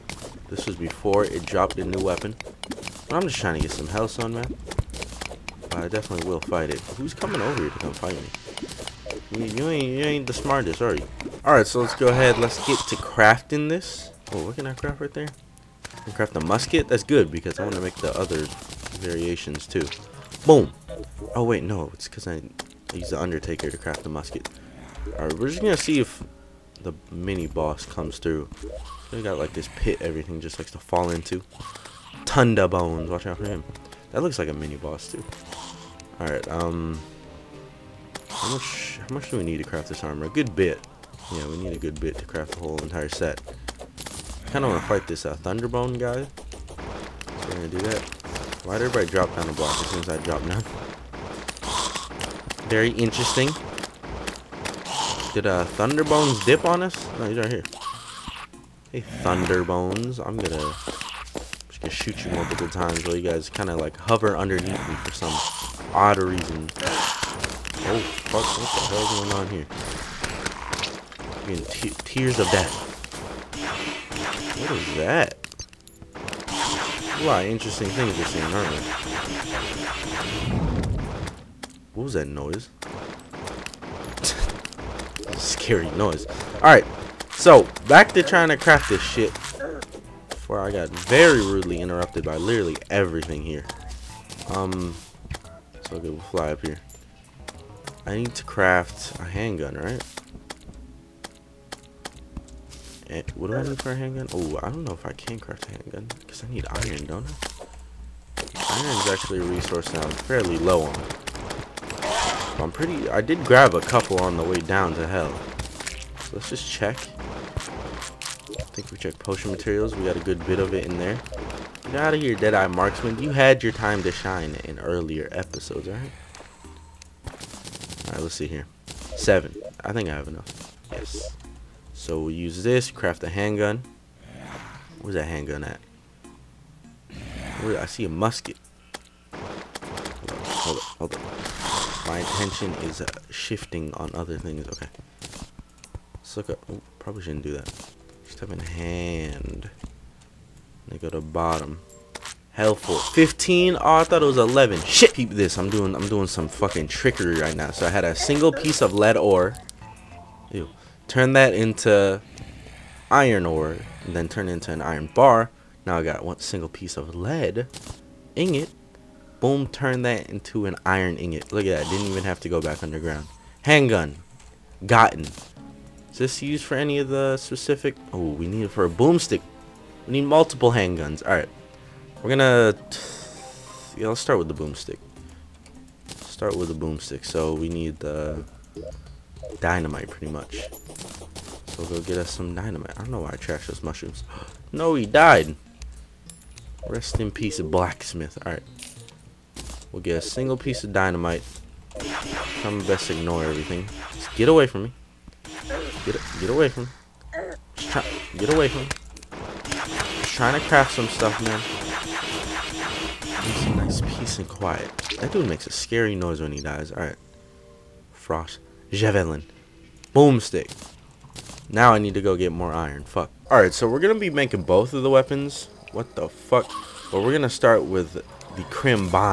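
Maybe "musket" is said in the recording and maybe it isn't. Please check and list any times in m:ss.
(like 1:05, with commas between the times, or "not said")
0:16, 0:24, 2:18.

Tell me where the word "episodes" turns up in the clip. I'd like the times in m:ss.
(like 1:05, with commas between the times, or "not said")
2:05.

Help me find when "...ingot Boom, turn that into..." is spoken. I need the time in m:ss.
2:48.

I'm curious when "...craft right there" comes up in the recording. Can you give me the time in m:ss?
0:14.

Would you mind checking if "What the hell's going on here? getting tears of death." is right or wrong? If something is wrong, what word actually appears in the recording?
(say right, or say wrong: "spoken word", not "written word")
right.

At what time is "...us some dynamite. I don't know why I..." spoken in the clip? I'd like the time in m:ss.
3:12.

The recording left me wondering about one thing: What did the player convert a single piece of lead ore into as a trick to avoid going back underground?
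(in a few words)
Iron ore.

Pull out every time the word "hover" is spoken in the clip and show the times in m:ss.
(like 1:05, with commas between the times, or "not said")
1:03.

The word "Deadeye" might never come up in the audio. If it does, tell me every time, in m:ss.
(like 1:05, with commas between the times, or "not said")
2:02.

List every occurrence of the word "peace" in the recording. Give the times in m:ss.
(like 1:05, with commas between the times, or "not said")
3:17, 3:34.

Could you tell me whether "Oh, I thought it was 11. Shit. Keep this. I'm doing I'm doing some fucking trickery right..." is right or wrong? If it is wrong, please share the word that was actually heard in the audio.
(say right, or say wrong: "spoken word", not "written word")
right.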